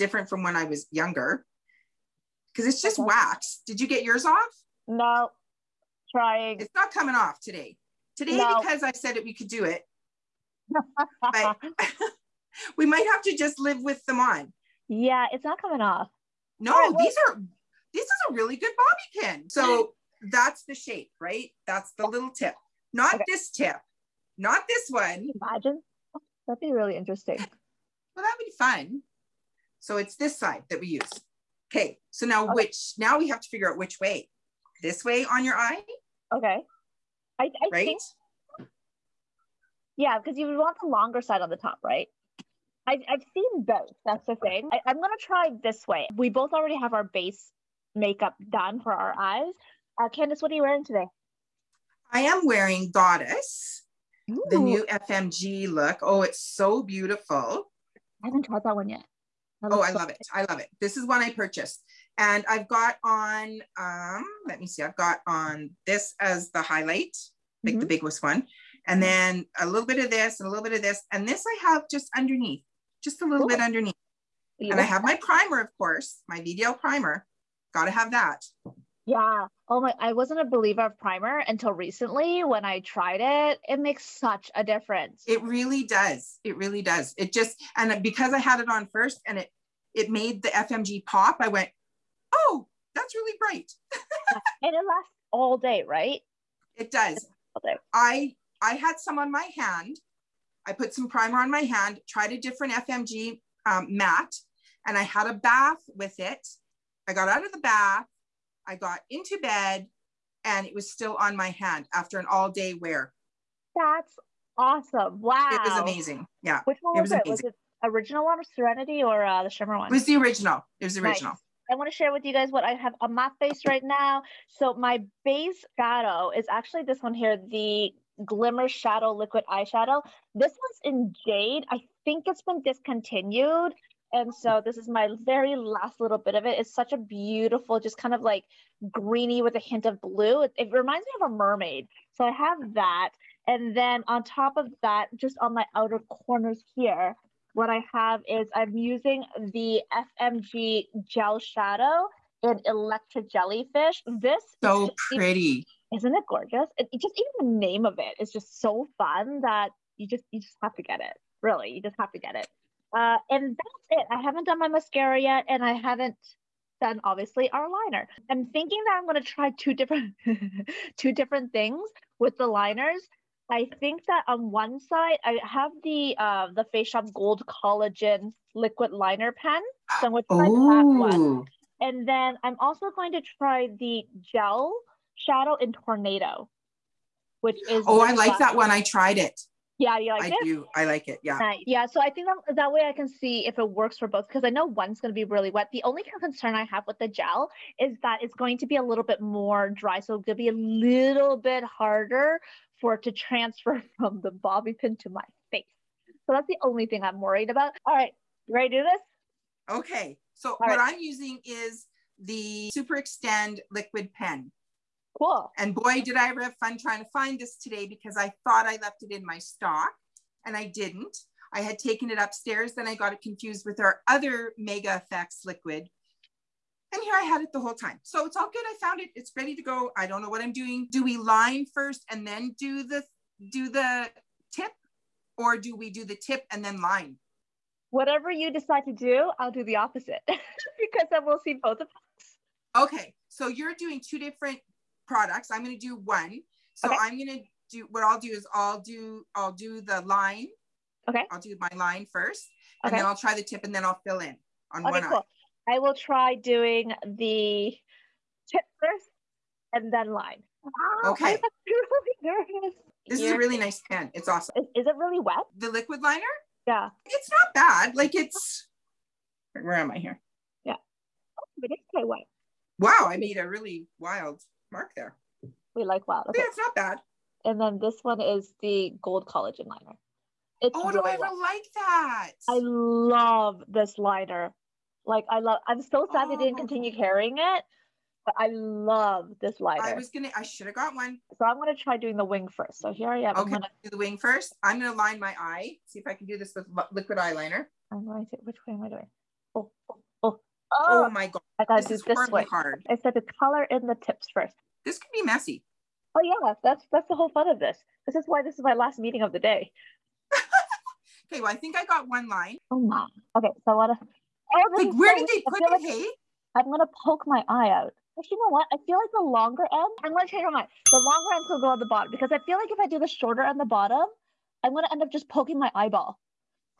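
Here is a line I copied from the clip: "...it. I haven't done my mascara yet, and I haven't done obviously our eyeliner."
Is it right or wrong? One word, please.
wrong.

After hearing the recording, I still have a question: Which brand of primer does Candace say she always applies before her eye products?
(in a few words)
VDL.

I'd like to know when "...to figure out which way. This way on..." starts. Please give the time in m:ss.
0:33.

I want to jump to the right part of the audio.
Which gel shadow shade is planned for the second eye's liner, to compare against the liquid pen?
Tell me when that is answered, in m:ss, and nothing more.
3:05.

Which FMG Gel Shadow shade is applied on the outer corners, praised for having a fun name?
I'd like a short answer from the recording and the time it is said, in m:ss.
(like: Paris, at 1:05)
Electra Jellyfish, at 2:32.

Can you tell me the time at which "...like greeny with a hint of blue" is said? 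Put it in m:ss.
2:18.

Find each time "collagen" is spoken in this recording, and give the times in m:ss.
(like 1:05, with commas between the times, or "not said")
2:57, 4:39.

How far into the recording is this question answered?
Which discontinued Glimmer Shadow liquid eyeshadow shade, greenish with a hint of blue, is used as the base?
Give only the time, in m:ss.
2:11.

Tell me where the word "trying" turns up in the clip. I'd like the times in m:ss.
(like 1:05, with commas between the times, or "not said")
0:06, 3:36.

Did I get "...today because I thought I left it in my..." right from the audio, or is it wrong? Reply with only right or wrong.
right.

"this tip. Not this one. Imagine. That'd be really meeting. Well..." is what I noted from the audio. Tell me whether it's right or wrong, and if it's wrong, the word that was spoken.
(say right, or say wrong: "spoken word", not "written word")
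wrong: "interesting", not "meeting".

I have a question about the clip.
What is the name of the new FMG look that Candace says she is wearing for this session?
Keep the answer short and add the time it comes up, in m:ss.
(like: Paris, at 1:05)
Goddess, at 0:52.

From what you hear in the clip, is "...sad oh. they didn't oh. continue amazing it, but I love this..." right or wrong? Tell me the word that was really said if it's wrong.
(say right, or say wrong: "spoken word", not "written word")
wrong: "carrying", not "amazing".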